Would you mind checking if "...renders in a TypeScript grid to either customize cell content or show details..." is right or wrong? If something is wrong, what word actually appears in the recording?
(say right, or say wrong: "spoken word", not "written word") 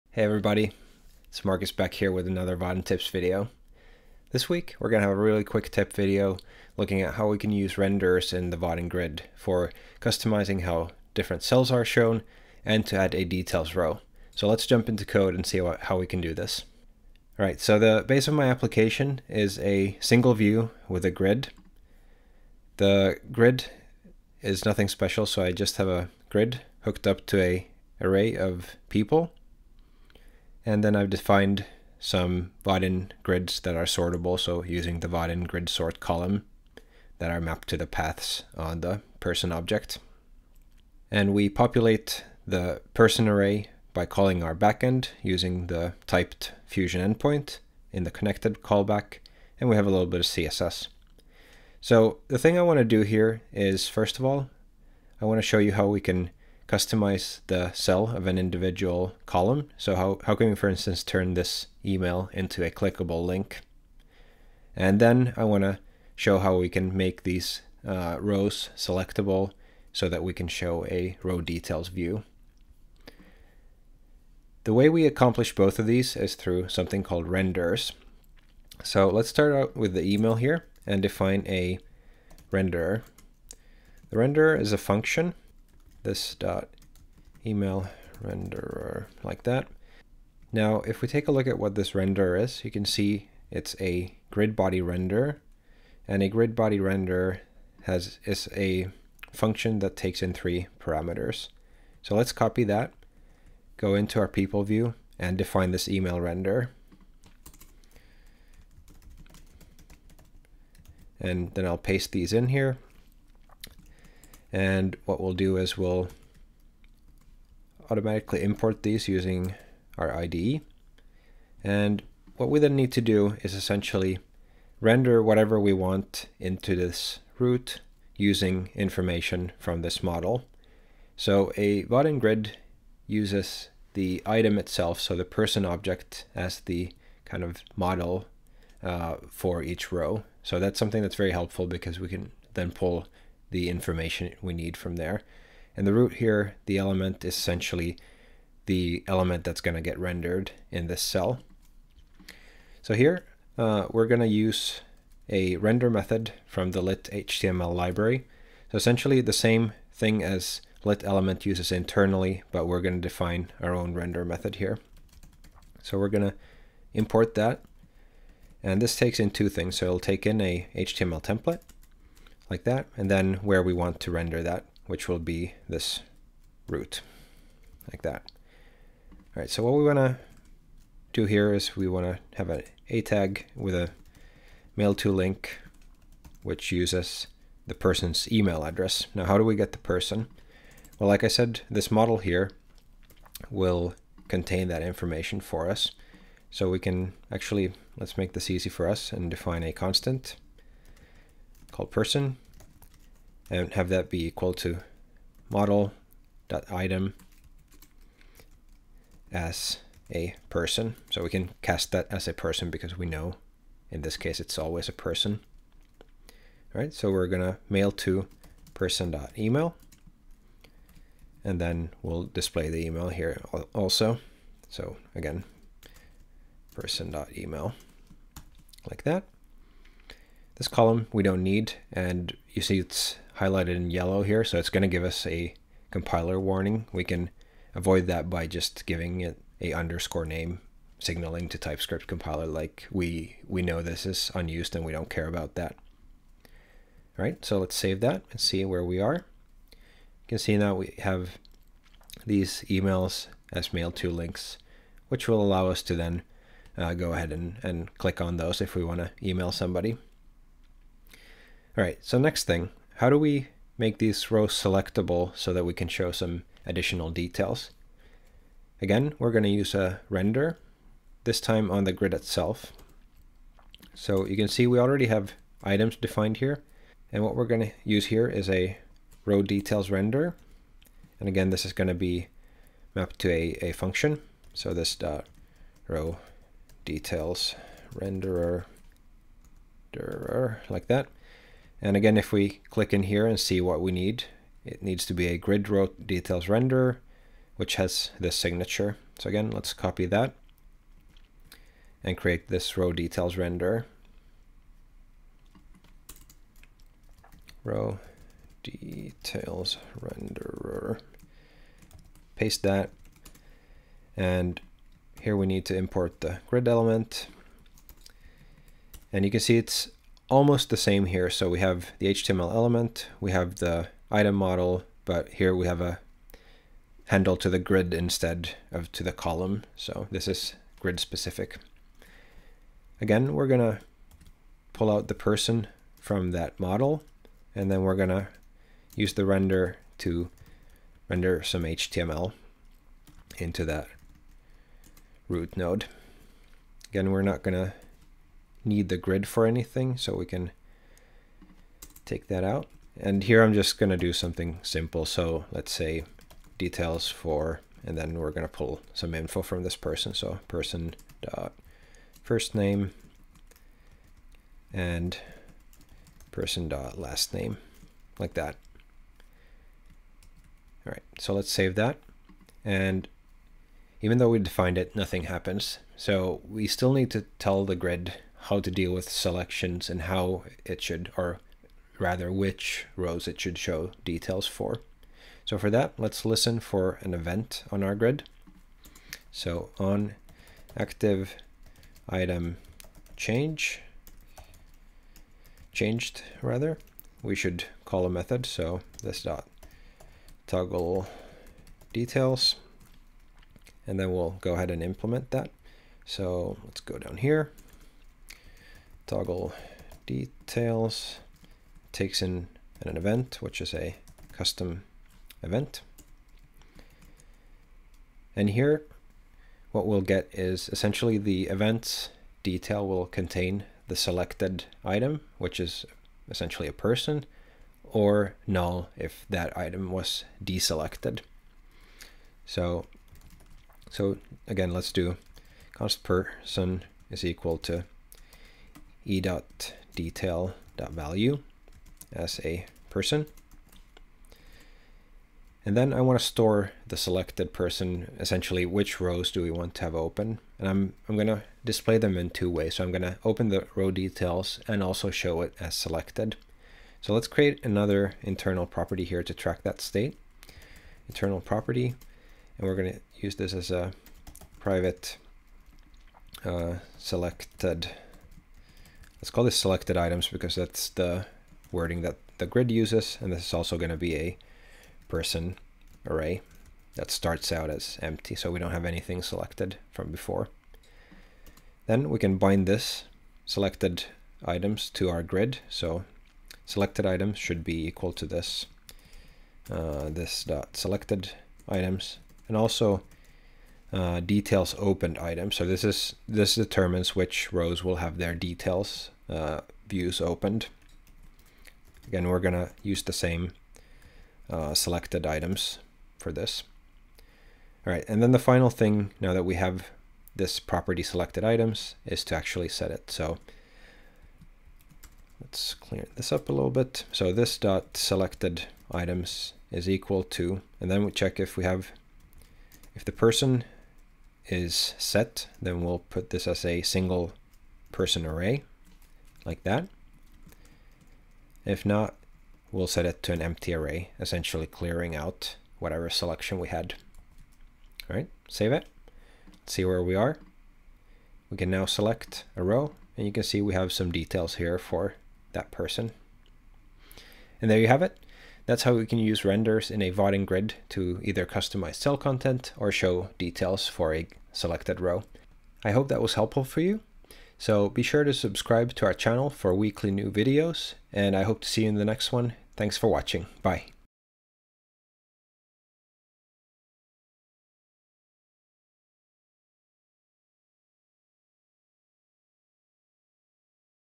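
wrong: "Vaadin", not "TypeScript".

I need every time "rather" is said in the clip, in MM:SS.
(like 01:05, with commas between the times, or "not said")
06:21, 06:36.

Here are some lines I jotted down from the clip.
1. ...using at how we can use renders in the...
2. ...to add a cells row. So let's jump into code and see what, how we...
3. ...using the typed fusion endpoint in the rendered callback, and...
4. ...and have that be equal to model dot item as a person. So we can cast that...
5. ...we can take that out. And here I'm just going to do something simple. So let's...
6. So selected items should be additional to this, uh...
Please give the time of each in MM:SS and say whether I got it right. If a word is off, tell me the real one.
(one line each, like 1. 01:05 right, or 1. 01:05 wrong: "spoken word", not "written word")
1. 00:06 wrong: "looking", not "using"
2. 00:12 wrong: "details", not "cells"
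3. 00:45 wrong: "connected", not "rendered"
4. 03:23 right
5. 05:50 right
6. 08:05 wrong: "equal", not "additional".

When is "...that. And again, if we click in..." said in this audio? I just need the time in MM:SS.
04:50.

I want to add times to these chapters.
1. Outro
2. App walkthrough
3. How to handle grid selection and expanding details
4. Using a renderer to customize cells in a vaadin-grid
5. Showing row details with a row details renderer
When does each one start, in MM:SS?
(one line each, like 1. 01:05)
1. 09:06
2. 00:16
3. 06:16
4. 00:52
5. 04:22.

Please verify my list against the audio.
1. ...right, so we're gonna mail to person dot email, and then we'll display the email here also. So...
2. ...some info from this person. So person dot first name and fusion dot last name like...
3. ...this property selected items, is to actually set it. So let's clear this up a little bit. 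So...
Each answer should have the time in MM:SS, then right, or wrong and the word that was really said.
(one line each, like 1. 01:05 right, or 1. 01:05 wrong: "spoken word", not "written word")
1. 03:36 right
2. 05:58 wrong: "person", not "fusion"
3. 08:30 right.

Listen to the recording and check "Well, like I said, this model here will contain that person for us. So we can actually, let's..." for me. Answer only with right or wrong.
wrong.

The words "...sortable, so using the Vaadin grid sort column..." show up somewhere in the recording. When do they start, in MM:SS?
00:33.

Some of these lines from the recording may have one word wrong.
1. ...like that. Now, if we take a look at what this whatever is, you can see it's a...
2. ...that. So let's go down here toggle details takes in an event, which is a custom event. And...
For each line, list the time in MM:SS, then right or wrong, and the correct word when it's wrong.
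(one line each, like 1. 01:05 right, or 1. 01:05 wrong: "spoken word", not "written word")
1. 01:29 wrong: "renderer", not "whatever"
2. 06:45 right.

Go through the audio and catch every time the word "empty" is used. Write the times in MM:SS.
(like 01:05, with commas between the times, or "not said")
07:58, 08:53.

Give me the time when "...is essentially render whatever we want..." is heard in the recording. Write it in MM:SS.
02:03.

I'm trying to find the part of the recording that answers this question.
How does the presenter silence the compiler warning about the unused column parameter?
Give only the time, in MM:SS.
03:59.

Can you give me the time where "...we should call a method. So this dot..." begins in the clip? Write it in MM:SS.
06:37.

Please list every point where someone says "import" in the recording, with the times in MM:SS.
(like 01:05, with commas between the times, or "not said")
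01:58, 02:46, 05:15.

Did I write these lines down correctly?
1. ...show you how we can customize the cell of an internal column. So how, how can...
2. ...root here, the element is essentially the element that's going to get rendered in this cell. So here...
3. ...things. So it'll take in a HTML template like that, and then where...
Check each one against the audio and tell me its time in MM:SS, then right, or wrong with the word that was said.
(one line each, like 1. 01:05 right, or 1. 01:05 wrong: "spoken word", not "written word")
1. 00:55 wrong: "individual", not "internal"
2. 02:25 right
3. 02:49 right.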